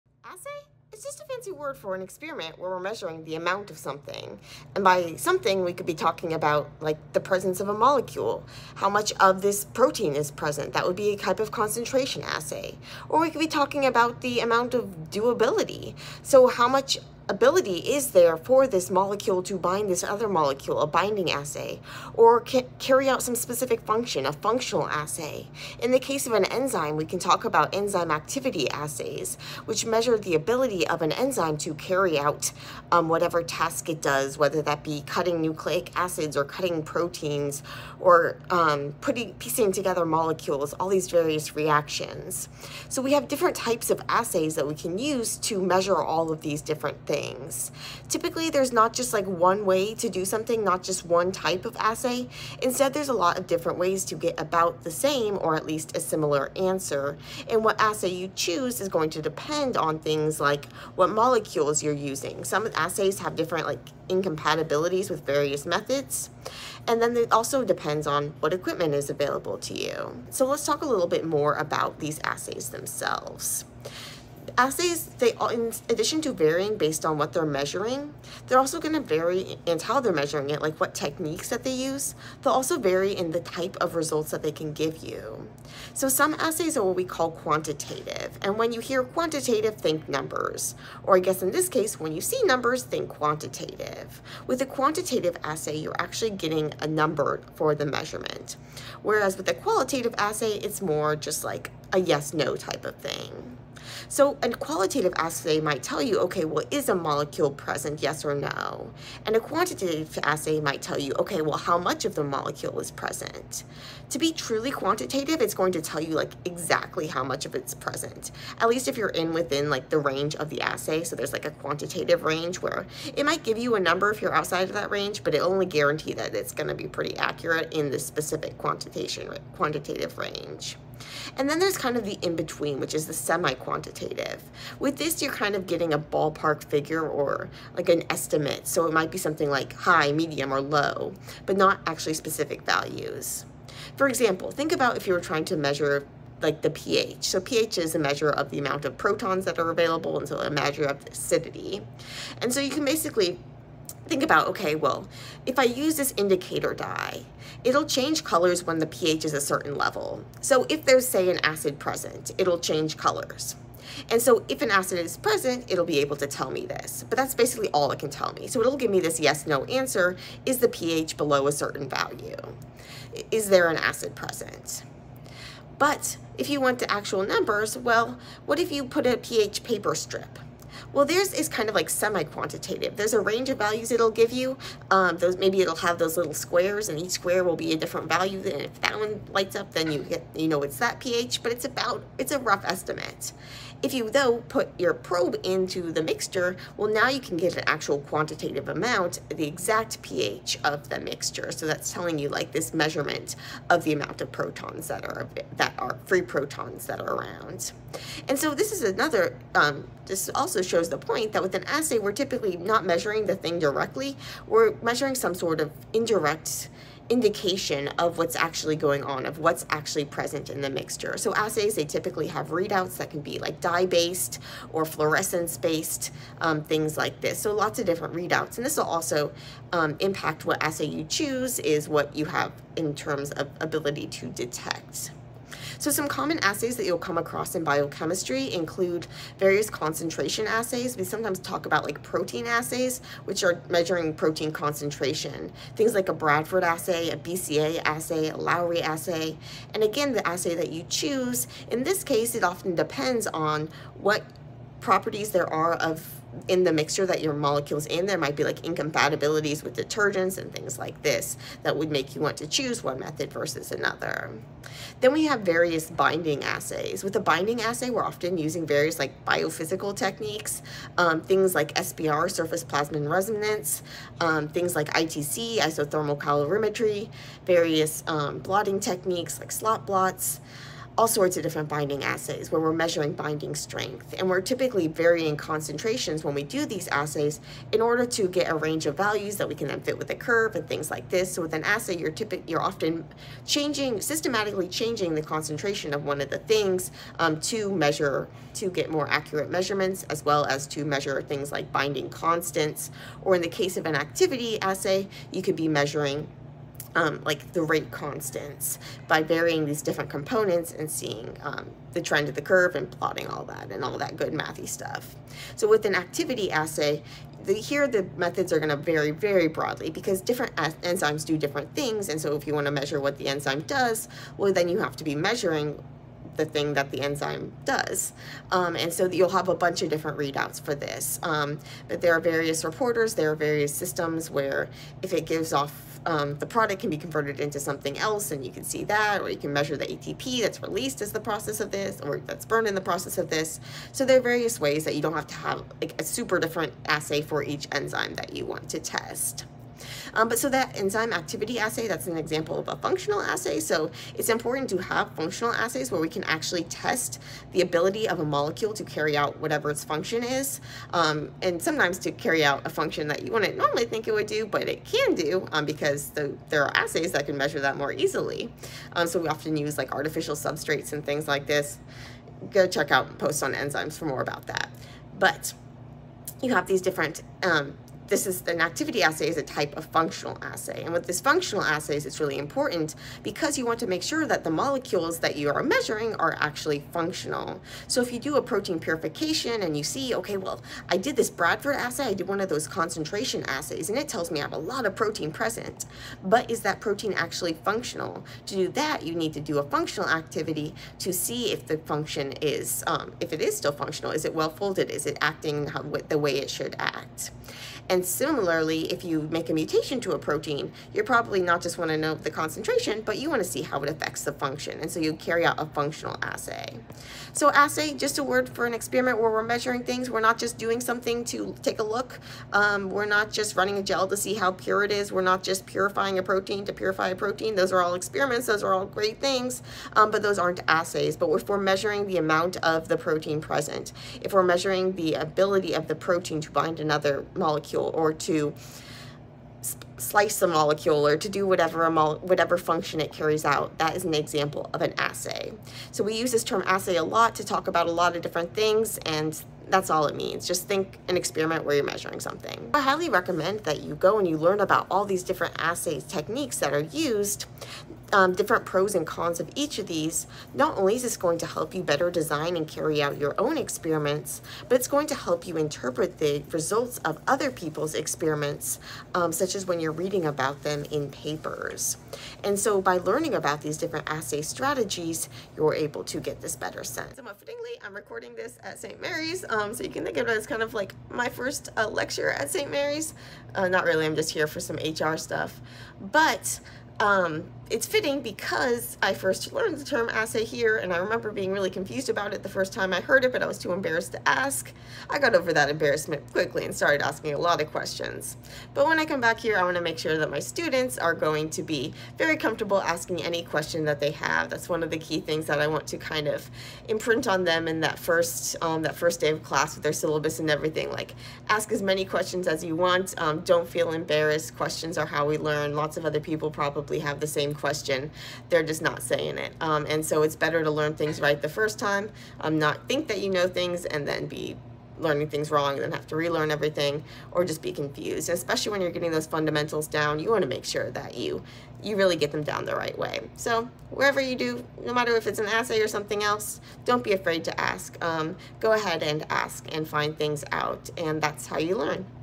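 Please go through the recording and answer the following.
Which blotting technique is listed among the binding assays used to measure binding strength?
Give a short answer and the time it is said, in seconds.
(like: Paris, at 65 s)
Slot blots, at 279 s.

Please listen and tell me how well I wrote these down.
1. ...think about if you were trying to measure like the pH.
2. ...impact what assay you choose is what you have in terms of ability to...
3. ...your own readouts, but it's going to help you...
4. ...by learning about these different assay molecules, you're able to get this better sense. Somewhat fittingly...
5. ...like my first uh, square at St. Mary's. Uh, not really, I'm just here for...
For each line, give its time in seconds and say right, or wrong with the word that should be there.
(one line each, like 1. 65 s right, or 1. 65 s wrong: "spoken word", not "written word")
1. 144 s right
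2. 229 s right
3. 463 s wrong: "experiments", not "readouts"
4. 472 s wrong: "strategies", not "molecules"
5. 480 s wrong: "lecture", not "square".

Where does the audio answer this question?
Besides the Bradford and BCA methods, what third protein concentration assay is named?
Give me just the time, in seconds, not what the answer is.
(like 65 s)
248 s.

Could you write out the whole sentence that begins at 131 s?
And then there's kind of the in-between, which is the semi-quantitative.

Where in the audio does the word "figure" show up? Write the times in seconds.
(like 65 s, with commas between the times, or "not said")
136 s.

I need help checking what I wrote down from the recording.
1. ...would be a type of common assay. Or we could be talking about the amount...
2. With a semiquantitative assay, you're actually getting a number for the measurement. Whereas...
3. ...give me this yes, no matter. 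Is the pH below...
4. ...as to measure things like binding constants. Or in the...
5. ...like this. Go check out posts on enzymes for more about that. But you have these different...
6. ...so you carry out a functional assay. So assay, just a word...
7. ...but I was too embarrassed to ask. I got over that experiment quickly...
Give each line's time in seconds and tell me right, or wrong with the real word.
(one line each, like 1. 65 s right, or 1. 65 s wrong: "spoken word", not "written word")
1. 10 s wrong: "concentration", not "common"
2. 94 s wrong: "quantitative", not "semiquantitative"
3. 168 s wrong: "answer", not "matter"
4. 300 s right
5. 371 s right
6. 414 s right
7. 493 s wrong: "embarrassment", not "experiment".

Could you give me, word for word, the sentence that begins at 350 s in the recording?
Um, but so that enzyme activity assay, that's an example of a functional assay.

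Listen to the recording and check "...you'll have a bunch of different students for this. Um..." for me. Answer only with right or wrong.
wrong.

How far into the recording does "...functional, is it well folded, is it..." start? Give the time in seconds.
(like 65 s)
403 s.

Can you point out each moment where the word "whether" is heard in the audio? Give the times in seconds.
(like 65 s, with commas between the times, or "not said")
34 s.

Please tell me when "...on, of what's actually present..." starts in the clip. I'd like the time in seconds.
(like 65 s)
219 s.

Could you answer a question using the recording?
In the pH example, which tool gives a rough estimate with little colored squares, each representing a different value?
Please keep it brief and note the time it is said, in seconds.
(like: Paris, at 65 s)
pH paper strip, at 179 s.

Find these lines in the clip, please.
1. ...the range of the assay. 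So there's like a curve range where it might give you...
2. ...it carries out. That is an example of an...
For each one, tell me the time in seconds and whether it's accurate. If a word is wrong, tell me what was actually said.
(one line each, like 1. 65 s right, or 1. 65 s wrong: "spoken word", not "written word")
1. 119 s wrong: "quantitative", not "curve"
2. 442 s right.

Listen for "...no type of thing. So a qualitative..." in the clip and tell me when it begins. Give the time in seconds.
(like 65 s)
102 s.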